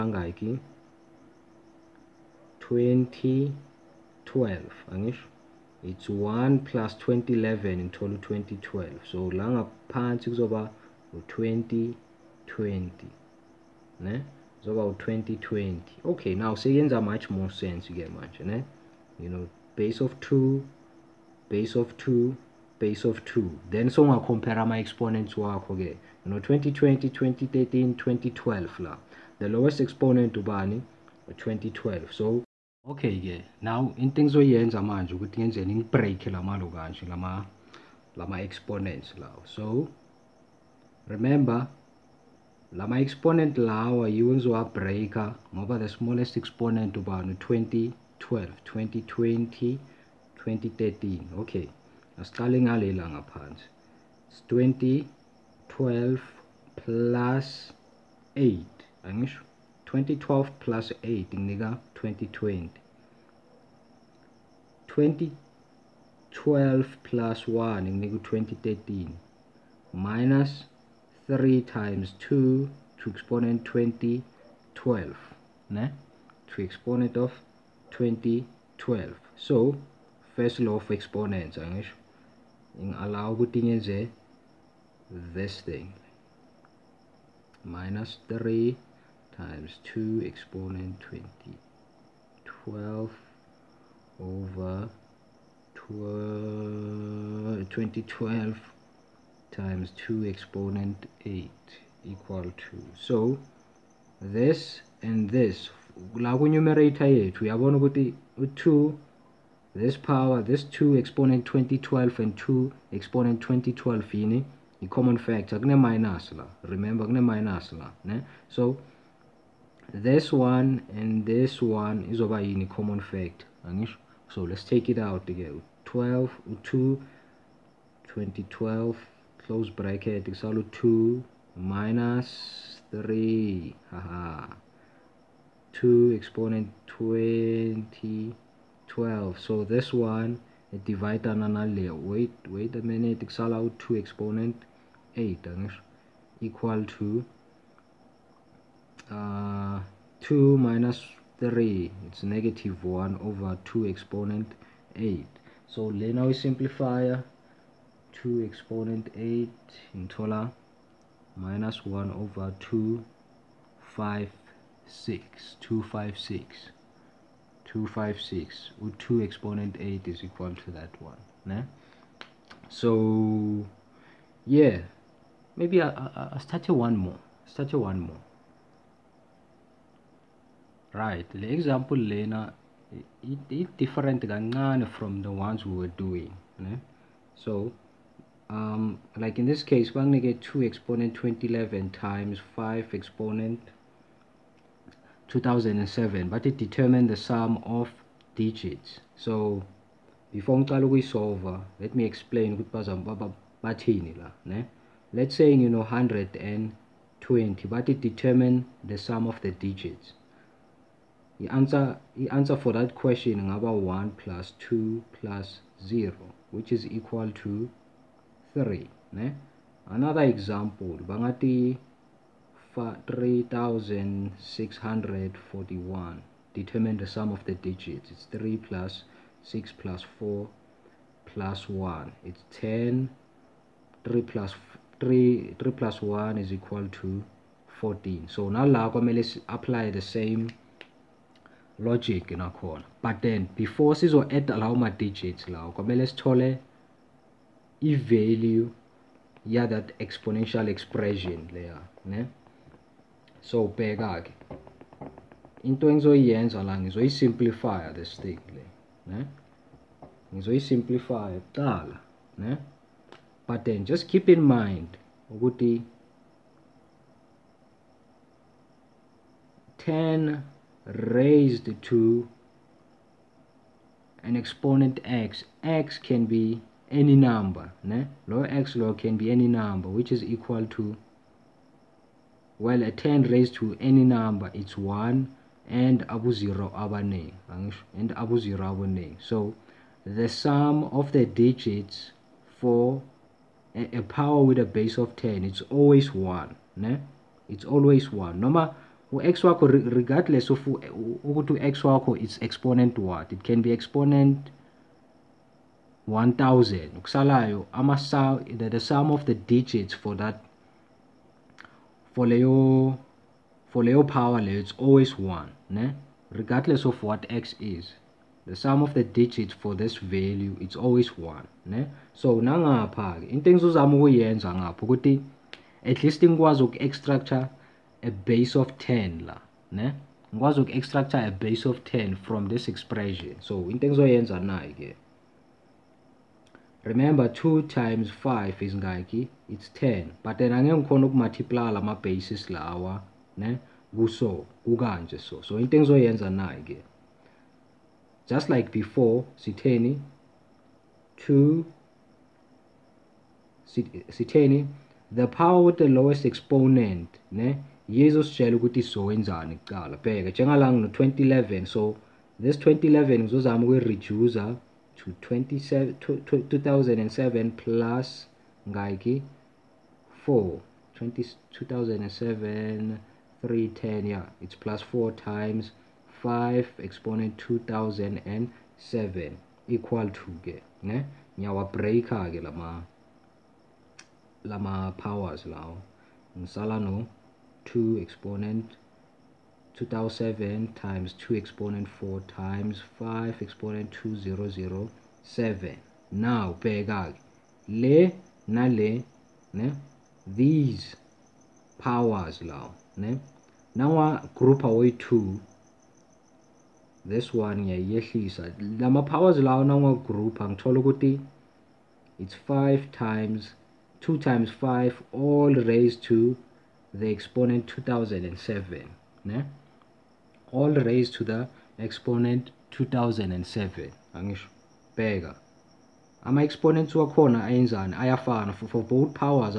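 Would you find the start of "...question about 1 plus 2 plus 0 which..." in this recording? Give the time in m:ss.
3:32.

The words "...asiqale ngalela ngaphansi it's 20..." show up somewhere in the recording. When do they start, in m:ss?
0:52.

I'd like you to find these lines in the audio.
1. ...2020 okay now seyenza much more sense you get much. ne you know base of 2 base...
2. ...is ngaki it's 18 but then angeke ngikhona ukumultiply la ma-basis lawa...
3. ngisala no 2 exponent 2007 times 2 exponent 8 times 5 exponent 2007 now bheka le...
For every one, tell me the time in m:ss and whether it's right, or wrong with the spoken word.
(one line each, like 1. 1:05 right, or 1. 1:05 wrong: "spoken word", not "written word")
1. 0:15 right
2. 5:38 wrong: "10", not "18"
3. 6:26 wrong: "4", not "8".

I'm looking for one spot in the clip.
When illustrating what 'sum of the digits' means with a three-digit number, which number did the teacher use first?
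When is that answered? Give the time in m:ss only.
3:25.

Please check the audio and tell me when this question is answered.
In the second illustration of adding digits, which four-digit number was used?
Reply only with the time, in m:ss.
3:43.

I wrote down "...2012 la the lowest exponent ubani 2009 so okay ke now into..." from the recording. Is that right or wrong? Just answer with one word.
wrong.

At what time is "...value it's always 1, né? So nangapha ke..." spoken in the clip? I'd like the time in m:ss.
5:19.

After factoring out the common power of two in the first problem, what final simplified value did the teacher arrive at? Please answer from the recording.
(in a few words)
-1/256.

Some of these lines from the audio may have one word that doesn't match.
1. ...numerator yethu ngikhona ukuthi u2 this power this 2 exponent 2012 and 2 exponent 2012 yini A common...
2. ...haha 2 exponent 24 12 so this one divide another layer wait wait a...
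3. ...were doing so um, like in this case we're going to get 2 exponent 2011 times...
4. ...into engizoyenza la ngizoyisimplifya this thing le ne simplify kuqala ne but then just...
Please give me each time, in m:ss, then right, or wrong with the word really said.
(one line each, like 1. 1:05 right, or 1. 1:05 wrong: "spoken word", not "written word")
1. 1:46 wrong: "uyabona", not "ngikhona"
2. 2:13 wrong: "20", not "24"
3. 3:05 right
4. 4:15 right.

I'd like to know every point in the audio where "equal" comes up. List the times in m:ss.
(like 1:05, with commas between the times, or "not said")
1:42, 2:26, 2:50, 3:36, 3:56, 4:40, 6:19.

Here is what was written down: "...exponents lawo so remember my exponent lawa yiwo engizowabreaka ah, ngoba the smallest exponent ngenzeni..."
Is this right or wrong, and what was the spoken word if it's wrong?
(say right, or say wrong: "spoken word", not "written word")
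wrong: "ubani", not "ngenzeni".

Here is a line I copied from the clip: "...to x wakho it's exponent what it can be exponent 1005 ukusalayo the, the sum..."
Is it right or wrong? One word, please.
wrong.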